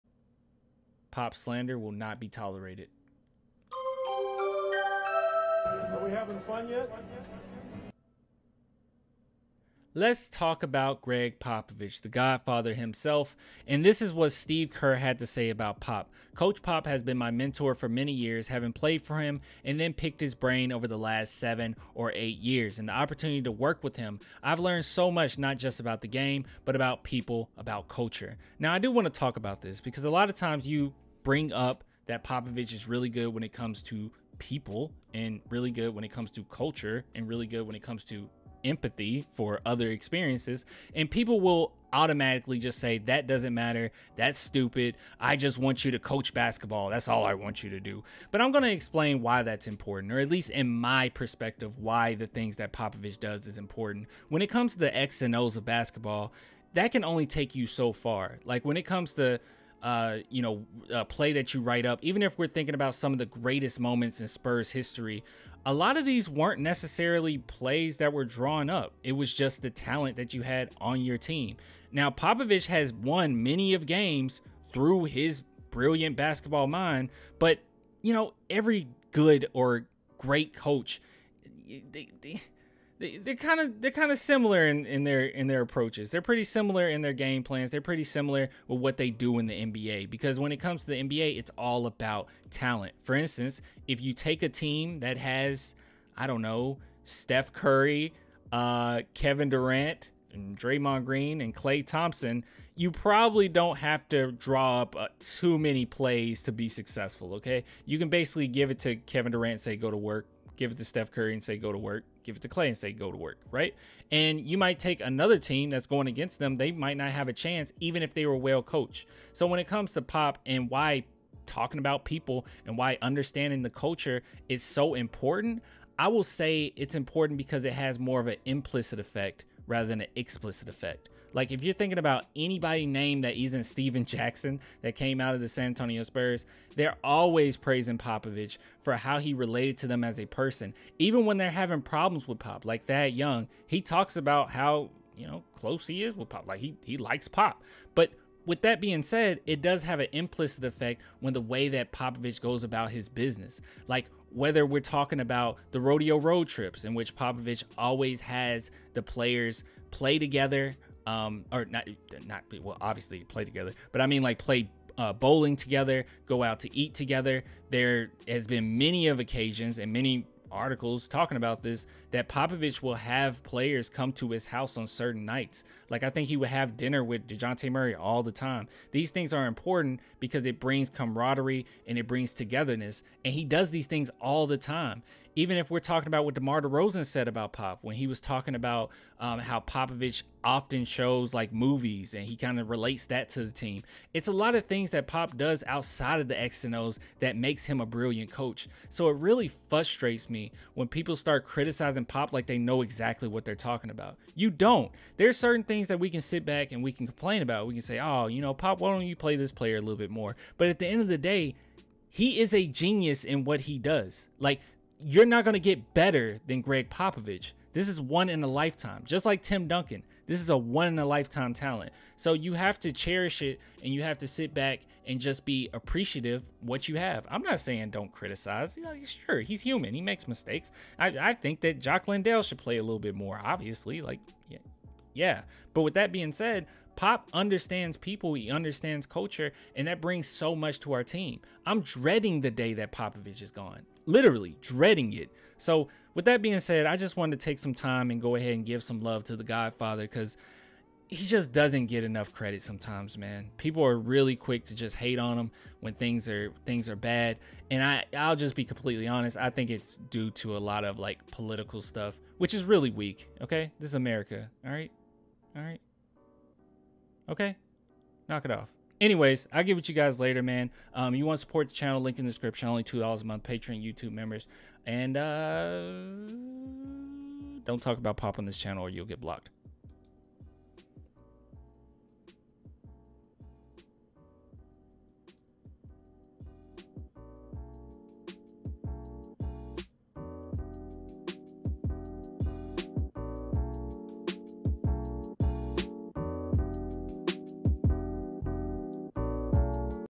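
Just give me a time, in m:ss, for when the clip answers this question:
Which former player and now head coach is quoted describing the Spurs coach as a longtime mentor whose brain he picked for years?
0:14.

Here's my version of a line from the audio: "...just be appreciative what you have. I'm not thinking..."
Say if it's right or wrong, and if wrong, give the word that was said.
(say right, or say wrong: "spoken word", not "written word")
wrong: "saying", not "thinking".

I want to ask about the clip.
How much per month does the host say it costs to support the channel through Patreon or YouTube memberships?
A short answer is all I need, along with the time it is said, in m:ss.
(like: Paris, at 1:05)
$2, at 4:32.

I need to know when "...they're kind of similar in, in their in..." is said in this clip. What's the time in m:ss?
1:23.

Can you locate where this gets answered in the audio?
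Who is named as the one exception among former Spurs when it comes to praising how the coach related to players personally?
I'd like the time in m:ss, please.
2:13.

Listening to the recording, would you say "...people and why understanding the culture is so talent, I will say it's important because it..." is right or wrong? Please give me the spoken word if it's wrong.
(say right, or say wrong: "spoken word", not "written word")
wrong: "important", not "talent".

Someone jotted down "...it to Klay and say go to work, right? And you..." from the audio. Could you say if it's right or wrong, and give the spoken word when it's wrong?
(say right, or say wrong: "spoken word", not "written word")
right.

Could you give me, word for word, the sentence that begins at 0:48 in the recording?
But I'm going to explain why that's important, or at least in my perspective, why the things that Popovich does is important.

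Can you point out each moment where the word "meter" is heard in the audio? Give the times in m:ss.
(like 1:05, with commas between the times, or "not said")
not said.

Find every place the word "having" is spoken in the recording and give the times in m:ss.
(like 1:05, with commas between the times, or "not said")
0:06, 0:18, 2:21.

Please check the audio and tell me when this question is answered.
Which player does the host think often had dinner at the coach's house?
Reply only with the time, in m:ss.
2:57.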